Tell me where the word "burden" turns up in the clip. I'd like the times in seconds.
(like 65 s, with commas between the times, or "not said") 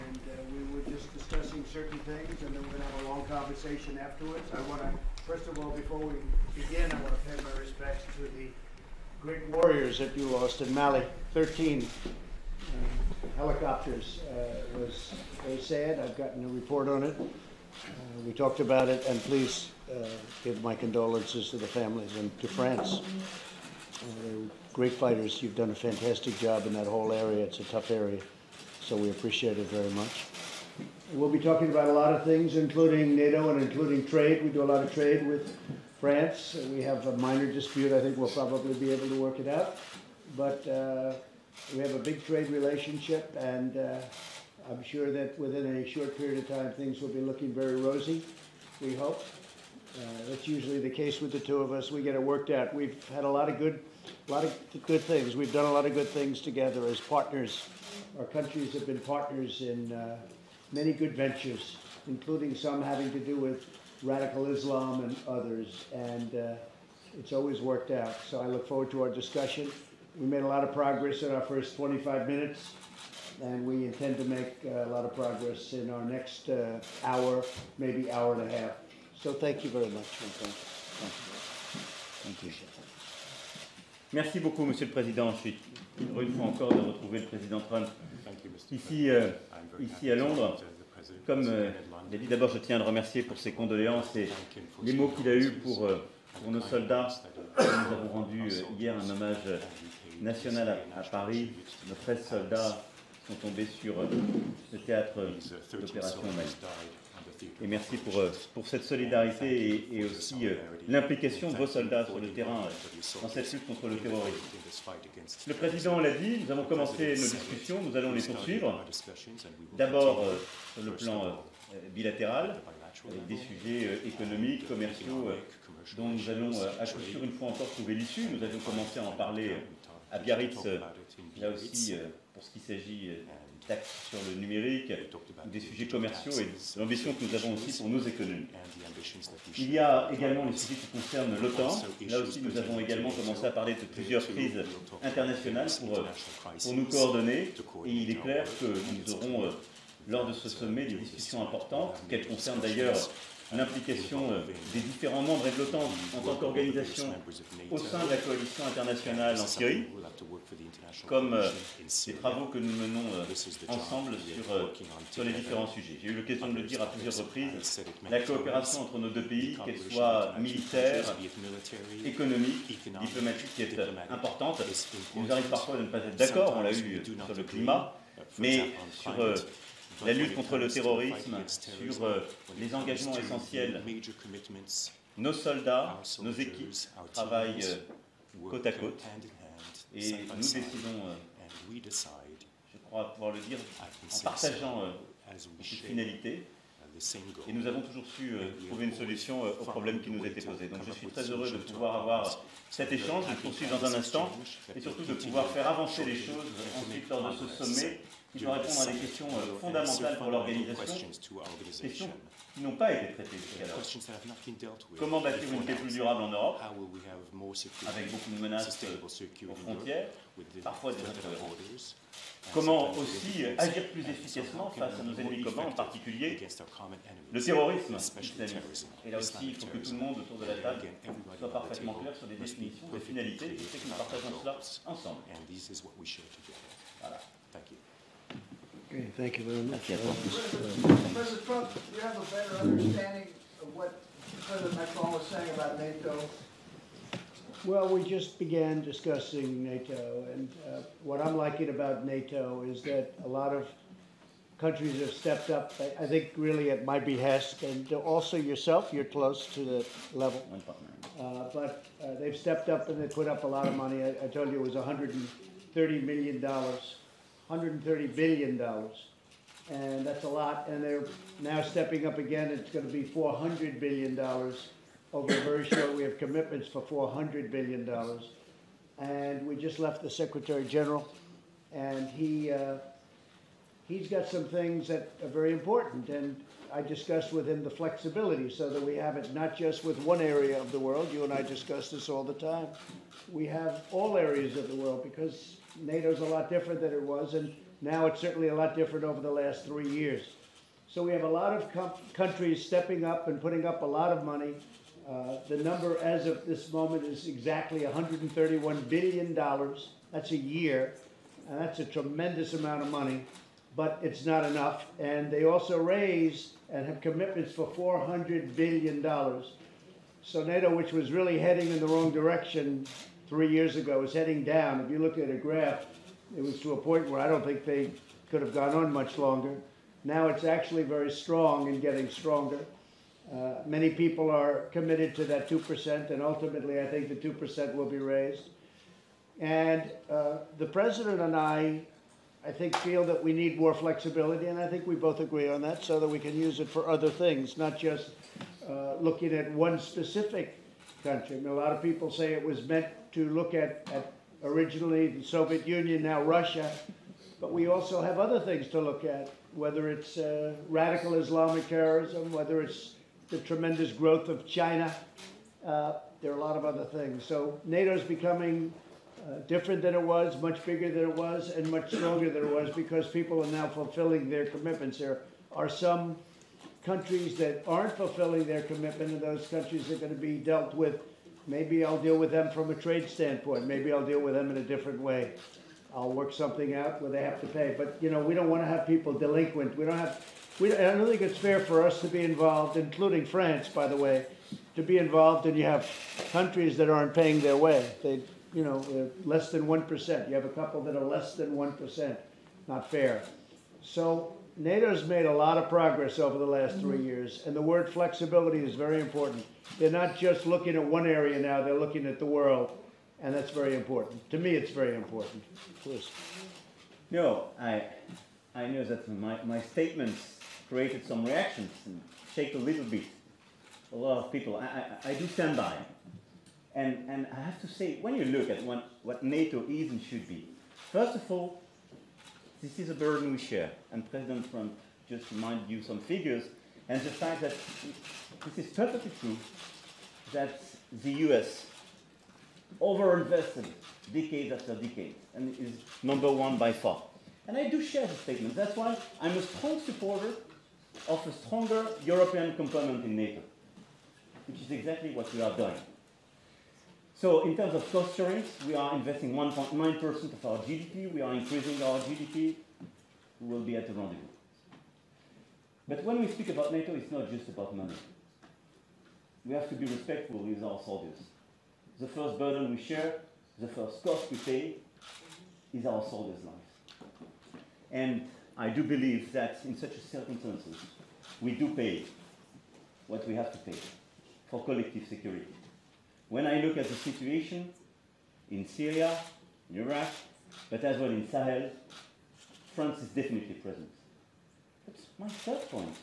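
432 s, 472 s.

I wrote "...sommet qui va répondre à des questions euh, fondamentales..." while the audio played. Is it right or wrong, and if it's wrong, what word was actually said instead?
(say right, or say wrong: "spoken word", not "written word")
right.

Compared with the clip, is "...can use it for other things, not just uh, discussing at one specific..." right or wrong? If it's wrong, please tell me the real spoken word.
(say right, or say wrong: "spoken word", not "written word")
wrong: "looking", not "discussing".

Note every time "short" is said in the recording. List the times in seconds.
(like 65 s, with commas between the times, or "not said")
45 s, 275 s.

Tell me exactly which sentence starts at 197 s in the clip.
Et nous avons toujours su euh, trouver une solution euh, aux problèmes qui nous étaient posés.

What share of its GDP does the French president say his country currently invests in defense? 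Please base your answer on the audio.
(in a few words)
1.9%.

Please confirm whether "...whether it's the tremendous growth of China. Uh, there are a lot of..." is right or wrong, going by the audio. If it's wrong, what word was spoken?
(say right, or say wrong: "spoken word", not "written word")
right.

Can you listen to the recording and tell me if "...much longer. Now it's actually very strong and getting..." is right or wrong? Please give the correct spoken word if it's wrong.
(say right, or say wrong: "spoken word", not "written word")
right.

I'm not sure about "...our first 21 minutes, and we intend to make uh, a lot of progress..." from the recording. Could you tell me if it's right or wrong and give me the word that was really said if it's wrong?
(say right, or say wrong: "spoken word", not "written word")
wrong: "25", not "21".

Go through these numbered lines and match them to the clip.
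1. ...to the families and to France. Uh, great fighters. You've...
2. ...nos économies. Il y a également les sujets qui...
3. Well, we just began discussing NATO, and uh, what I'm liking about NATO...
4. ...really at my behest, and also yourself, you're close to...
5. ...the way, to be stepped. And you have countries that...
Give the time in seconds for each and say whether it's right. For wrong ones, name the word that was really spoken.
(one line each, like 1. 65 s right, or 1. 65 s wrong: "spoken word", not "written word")
1. 21 s right
2. 137 s right
3. 247 s right
4. 256 s right
5. 393 s wrong: "involved", not "stepped".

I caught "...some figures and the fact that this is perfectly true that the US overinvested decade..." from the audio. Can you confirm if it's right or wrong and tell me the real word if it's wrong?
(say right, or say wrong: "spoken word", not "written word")
right.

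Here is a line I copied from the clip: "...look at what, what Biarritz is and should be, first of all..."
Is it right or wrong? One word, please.
wrong.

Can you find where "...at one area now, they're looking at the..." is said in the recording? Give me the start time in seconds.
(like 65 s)
410 s.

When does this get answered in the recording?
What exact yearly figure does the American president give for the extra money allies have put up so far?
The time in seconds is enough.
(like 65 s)
307 s.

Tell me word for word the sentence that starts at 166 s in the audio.
J'ai eu l'occasion de le dire à plusieurs reprises, la coopération entre nos deux pays, qu'elle soit militaire, économique, diplomatique, est importante.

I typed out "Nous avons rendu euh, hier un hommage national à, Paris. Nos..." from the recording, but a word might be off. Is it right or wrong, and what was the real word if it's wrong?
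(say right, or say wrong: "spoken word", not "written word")
right.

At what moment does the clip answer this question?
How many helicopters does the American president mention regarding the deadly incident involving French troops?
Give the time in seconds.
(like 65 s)
11 s.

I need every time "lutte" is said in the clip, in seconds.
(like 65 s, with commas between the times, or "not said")
113 s, 180 s.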